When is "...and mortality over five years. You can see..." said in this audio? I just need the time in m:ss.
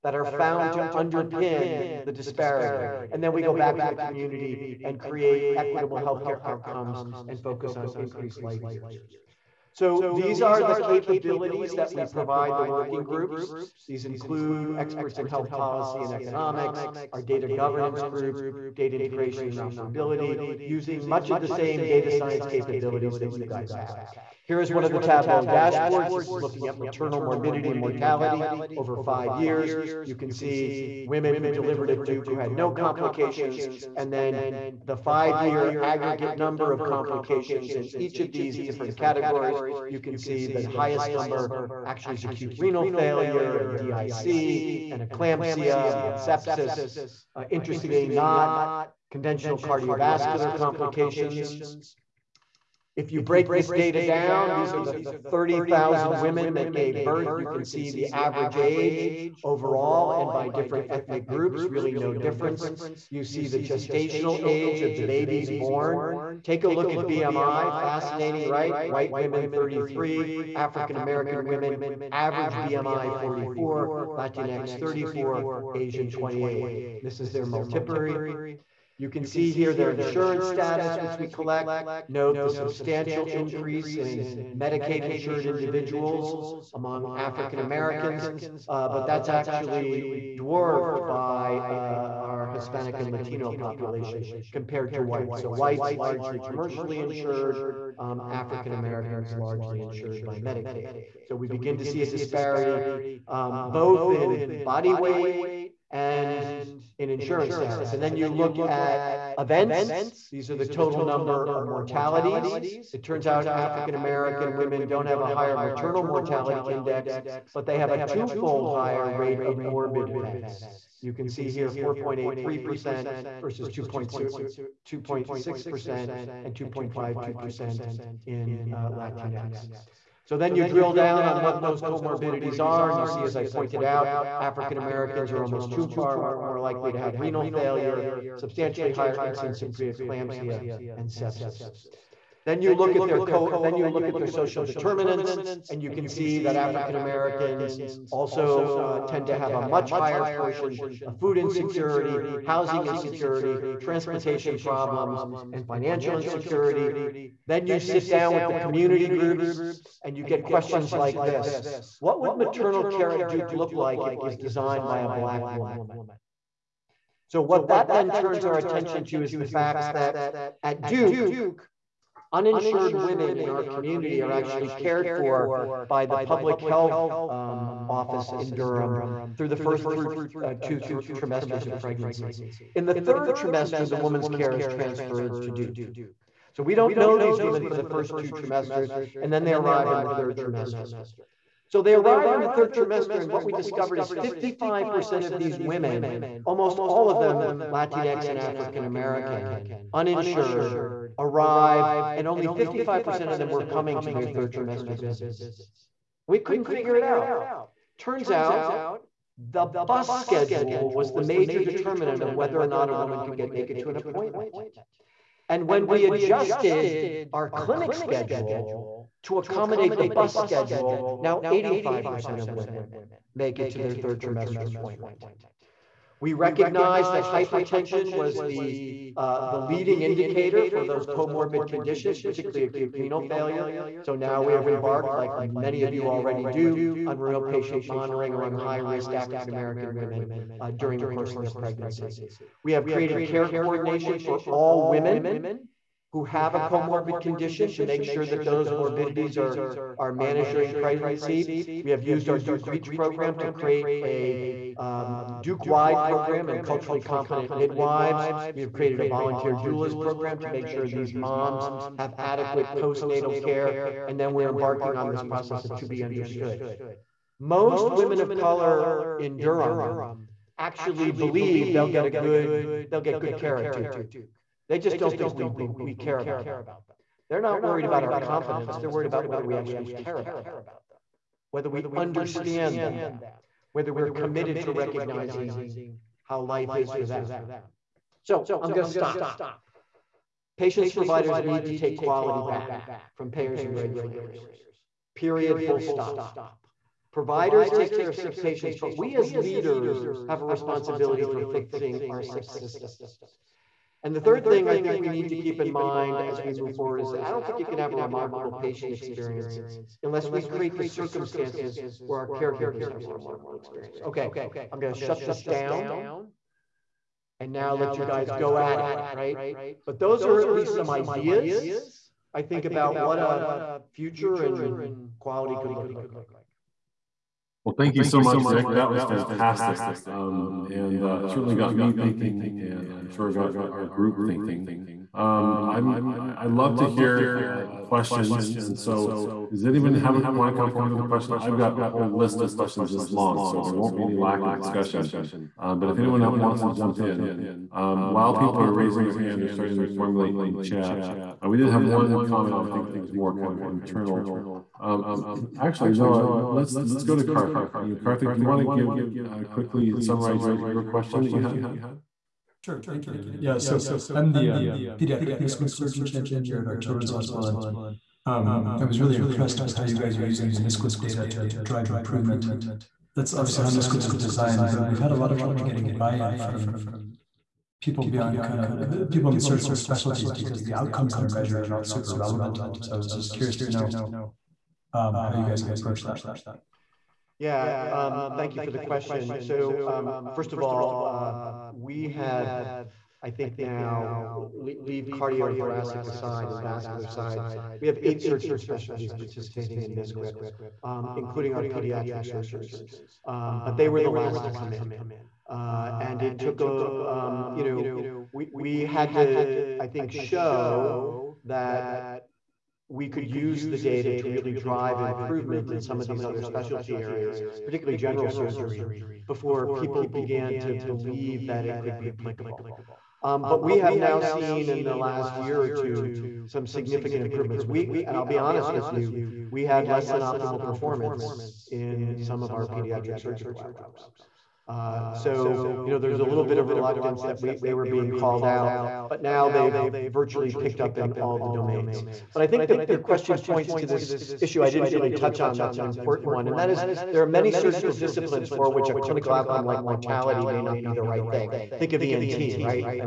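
0:27.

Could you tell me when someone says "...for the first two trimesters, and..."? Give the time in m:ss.
3:07.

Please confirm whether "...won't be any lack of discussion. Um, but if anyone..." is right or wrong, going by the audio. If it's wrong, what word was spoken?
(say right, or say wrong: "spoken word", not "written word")
right.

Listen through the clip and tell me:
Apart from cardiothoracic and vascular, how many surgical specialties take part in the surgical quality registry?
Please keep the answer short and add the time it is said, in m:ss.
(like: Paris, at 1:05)
8, at 6:38.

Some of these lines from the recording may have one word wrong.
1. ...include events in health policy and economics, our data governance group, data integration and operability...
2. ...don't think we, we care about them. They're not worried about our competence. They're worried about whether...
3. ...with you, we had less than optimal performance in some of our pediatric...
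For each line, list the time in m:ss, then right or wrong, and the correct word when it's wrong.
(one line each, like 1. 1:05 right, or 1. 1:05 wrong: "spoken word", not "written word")
1. 0:14 wrong: "experts", not "events"
2. 4:34 right
3. 7:08 right.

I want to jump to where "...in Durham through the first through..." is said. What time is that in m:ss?
2:58.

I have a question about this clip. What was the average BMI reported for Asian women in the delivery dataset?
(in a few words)
28.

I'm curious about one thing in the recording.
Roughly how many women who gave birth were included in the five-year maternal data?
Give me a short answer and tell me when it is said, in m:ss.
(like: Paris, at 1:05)
30,000, at 0:55.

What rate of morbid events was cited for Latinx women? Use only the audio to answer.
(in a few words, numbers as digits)
2.52%.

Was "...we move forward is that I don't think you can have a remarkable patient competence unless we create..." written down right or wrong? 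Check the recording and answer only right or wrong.
wrong.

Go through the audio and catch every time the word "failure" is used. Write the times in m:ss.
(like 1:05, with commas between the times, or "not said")
0:42, 2:17, 3:53.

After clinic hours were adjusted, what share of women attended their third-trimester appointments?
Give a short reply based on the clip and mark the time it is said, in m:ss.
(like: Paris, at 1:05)
85%, at 3:41.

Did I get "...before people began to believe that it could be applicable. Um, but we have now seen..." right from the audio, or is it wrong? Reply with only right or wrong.
right.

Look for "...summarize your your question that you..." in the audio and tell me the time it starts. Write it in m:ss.
5:59.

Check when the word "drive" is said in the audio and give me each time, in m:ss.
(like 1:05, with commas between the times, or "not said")
6:11, 6:54.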